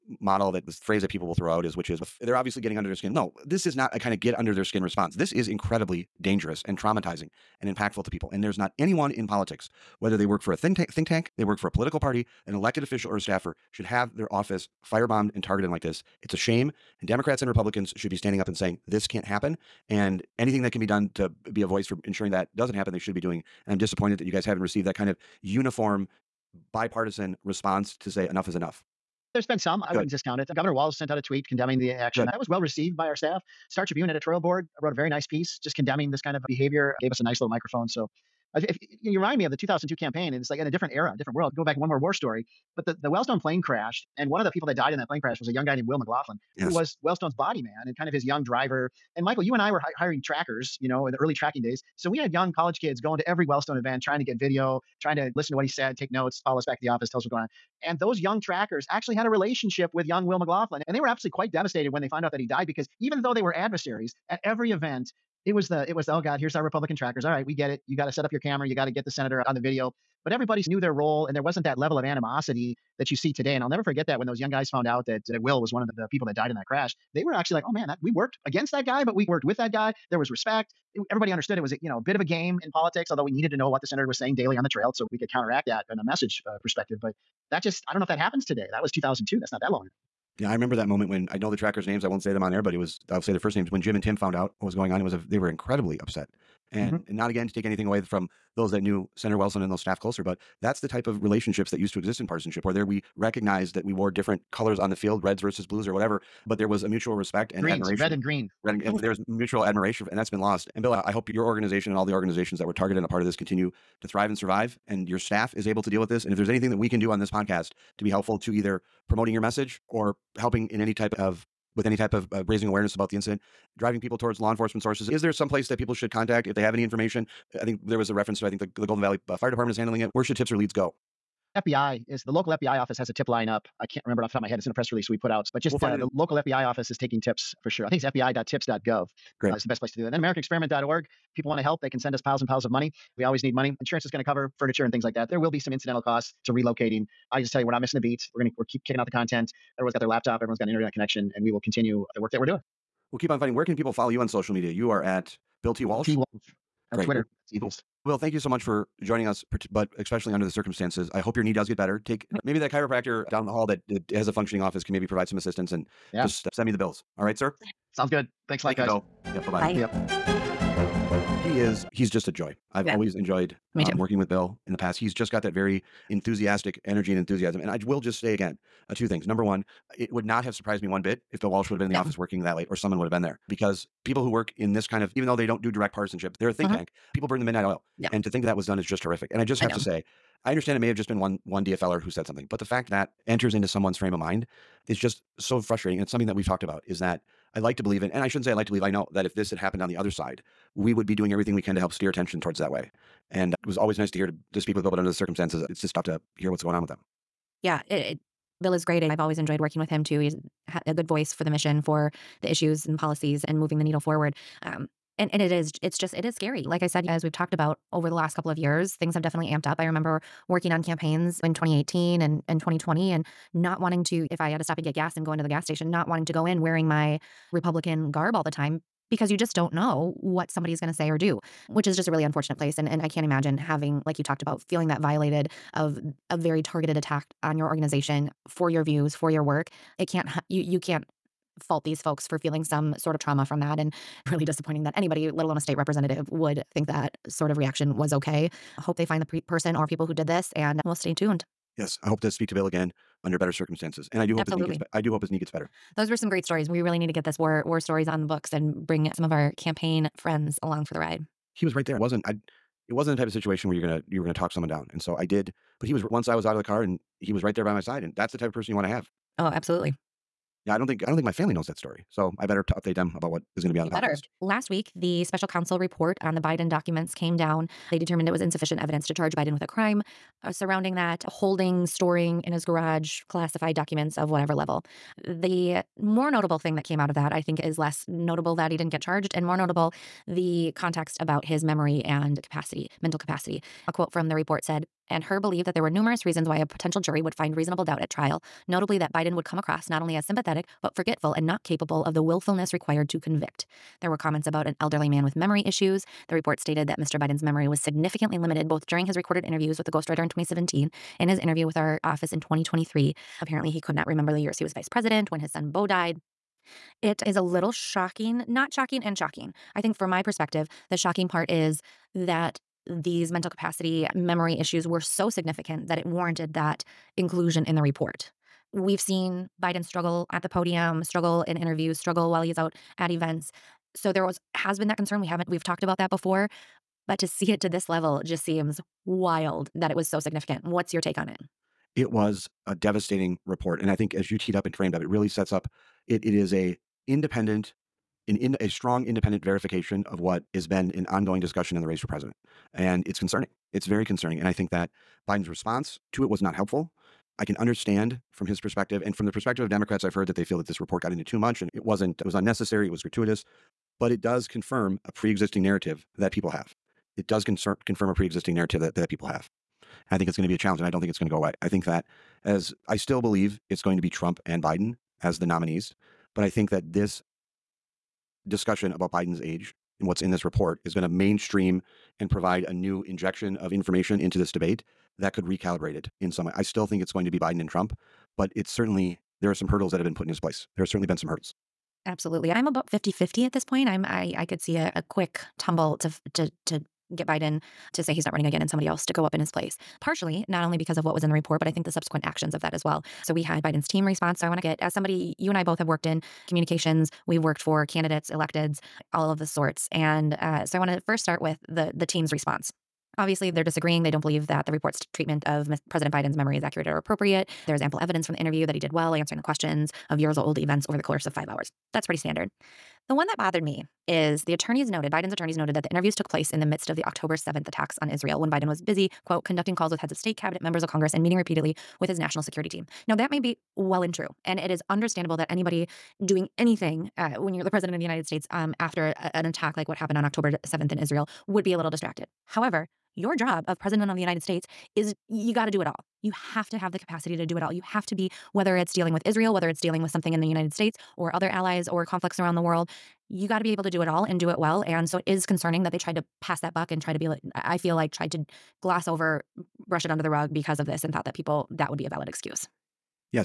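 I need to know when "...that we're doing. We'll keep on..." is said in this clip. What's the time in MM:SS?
02:32.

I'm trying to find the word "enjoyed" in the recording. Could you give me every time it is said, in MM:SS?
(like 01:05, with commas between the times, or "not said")
02:53, 03:29.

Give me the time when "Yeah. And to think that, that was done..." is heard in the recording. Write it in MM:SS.
03:07.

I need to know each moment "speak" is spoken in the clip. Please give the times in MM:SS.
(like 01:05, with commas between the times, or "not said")
03:24, 04:12.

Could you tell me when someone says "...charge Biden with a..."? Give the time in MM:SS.
04:39.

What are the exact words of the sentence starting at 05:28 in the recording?
We've seen Biden struggle at the podium, struggle in interviews, struggle while he's out at events.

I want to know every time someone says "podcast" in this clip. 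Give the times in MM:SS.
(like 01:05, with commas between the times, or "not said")
01:57, 04:33.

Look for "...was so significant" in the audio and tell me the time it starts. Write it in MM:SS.
05:39.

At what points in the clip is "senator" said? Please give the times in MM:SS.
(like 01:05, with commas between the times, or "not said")
01:09, 01:23, 01:39.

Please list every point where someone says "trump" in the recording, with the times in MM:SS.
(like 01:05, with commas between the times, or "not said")
06:14, 06:27.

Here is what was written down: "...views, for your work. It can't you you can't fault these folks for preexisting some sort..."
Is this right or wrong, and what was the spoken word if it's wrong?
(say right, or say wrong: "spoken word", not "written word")
wrong: "feeling", not "preexisting".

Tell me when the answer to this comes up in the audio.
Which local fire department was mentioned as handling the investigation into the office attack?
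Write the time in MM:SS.
02:08.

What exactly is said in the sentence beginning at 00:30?
Governor Walz sent out a tweet condemning the action.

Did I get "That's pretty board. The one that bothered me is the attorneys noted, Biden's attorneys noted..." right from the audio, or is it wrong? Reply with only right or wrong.
wrong.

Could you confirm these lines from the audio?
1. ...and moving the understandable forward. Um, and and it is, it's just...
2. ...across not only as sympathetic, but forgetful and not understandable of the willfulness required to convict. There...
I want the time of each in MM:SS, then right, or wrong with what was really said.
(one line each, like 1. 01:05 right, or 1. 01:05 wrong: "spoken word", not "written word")
1. 03:33 wrong: "needle", not "understandable"
2. 04:59 wrong: "capable", not "understandable".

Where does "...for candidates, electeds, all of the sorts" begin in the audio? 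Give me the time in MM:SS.
06:47.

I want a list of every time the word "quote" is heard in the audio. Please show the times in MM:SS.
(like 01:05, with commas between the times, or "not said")
04:53, 07:09.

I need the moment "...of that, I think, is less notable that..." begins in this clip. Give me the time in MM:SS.
04:47.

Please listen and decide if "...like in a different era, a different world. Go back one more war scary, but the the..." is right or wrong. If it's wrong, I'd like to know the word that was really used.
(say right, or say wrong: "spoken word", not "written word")
wrong: "story", not "scary".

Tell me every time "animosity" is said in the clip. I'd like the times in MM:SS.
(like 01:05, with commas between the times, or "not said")
01:12.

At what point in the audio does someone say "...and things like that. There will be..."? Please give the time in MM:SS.
02:24.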